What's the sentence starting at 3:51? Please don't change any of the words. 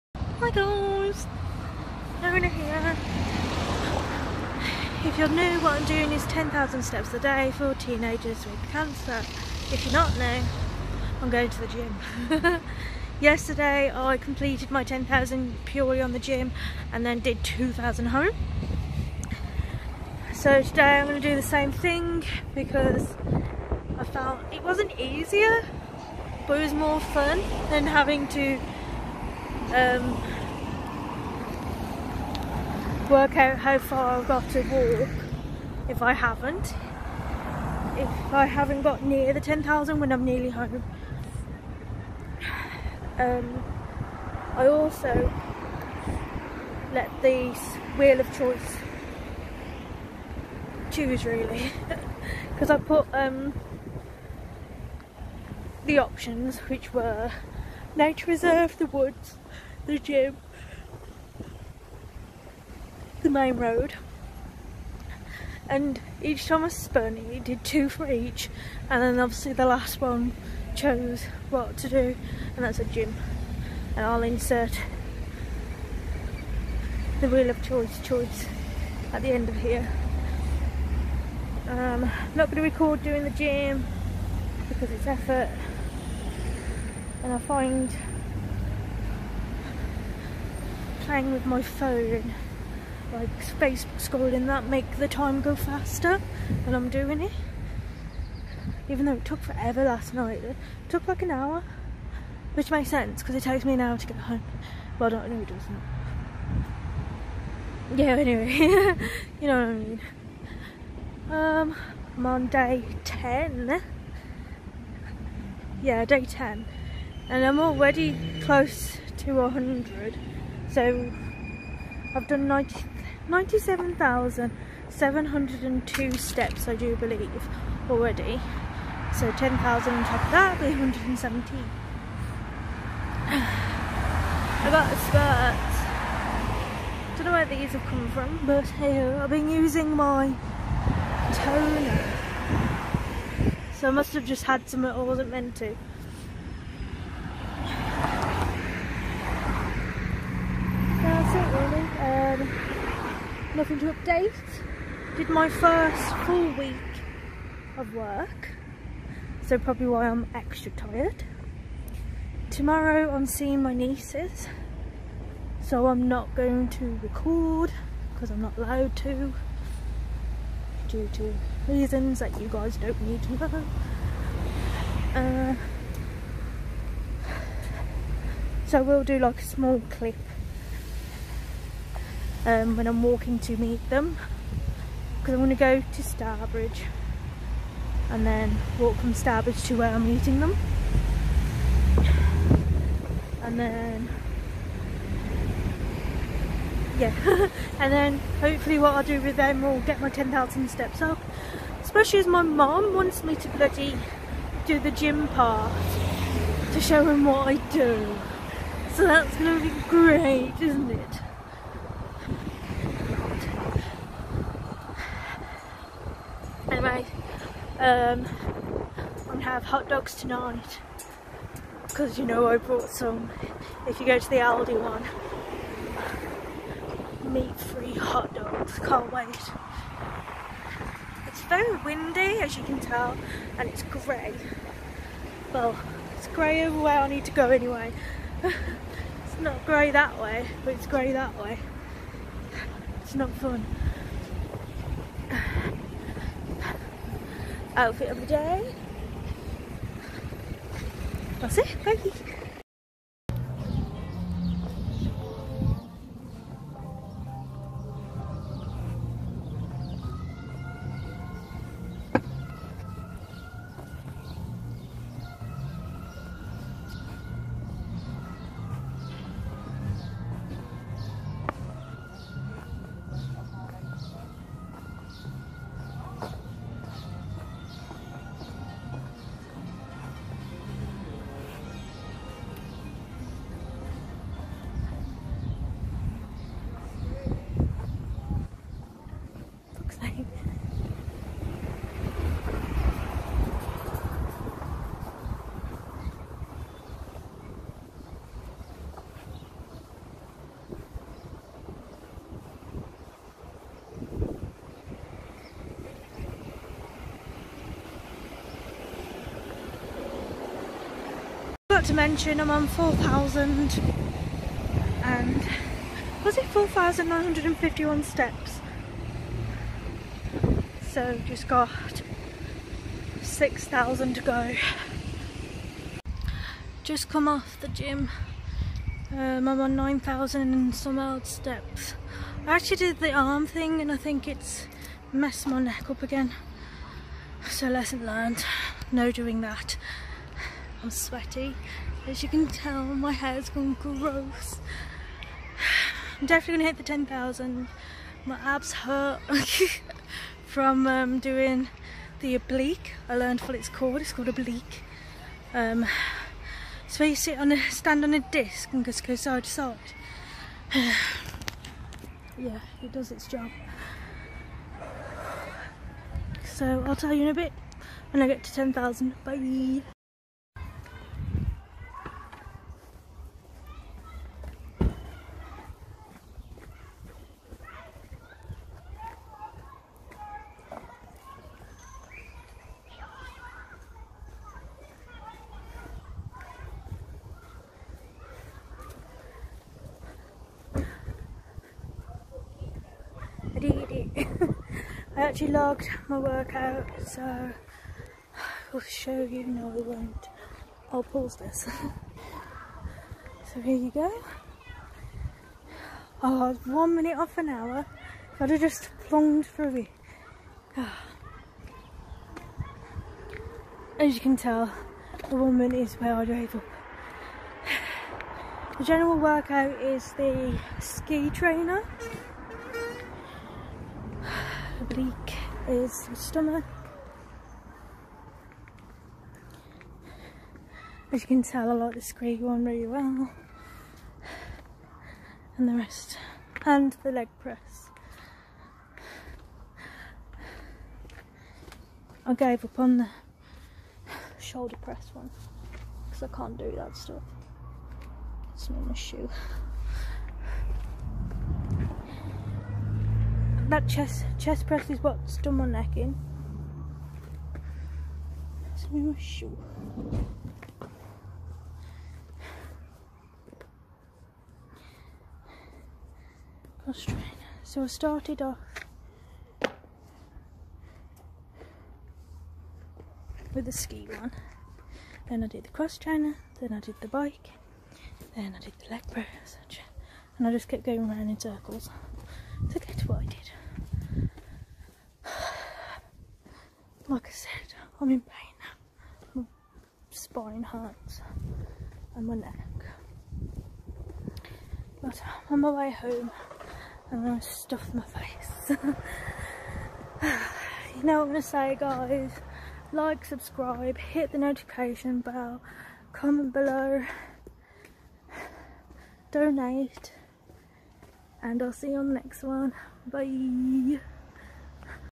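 It's very windy as you can tell and it's grey.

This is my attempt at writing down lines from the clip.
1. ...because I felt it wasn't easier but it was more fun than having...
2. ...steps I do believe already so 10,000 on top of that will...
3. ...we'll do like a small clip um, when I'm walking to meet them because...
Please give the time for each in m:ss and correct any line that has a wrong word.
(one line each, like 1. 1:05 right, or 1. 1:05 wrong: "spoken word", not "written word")
1. 0:22 right
2. 2:06 right
3. 2:58 right.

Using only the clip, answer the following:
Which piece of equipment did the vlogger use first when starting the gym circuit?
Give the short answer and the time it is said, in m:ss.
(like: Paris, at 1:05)
The ski one, at 7:53.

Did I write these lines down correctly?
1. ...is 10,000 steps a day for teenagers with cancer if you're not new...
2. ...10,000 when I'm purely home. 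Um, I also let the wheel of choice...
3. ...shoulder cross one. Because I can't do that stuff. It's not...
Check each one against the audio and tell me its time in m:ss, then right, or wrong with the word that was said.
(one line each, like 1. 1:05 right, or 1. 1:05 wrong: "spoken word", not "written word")
1. 0:06 right
2. 0:39 wrong: "nearly", not "purely"
3. 7:24 wrong: "press", not "cross".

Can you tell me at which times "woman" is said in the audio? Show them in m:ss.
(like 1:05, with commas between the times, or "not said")
6:55.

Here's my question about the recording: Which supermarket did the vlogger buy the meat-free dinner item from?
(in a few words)
Aldi.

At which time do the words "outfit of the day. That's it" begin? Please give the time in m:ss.
4:07.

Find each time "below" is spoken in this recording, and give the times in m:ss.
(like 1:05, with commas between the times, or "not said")
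8:26.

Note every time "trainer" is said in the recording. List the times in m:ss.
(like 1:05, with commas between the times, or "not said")
7:01, 7:55.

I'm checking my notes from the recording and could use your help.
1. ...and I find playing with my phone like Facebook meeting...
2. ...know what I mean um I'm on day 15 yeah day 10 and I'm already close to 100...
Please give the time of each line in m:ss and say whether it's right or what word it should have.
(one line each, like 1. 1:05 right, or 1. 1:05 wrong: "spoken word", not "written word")
1. 1:27 wrong: "scrolling", not "meeting"
2. 1:49 wrong: "10", not "15".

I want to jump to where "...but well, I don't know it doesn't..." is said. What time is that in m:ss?
1:44.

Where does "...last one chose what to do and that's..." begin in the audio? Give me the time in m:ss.
1:09.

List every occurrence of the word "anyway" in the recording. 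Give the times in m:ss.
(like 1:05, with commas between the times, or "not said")
1:48, 3:57.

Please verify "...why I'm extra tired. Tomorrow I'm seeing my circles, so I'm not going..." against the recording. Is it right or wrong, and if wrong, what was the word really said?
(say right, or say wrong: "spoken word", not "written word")
wrong: "nieces", not "circles".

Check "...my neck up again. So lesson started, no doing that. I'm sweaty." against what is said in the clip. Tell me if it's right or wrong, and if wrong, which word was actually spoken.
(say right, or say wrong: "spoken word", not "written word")
wrong: "learned", not "started".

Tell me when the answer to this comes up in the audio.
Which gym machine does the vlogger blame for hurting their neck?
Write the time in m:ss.
7:34.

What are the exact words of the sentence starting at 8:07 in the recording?
Like I said, I'm in pain.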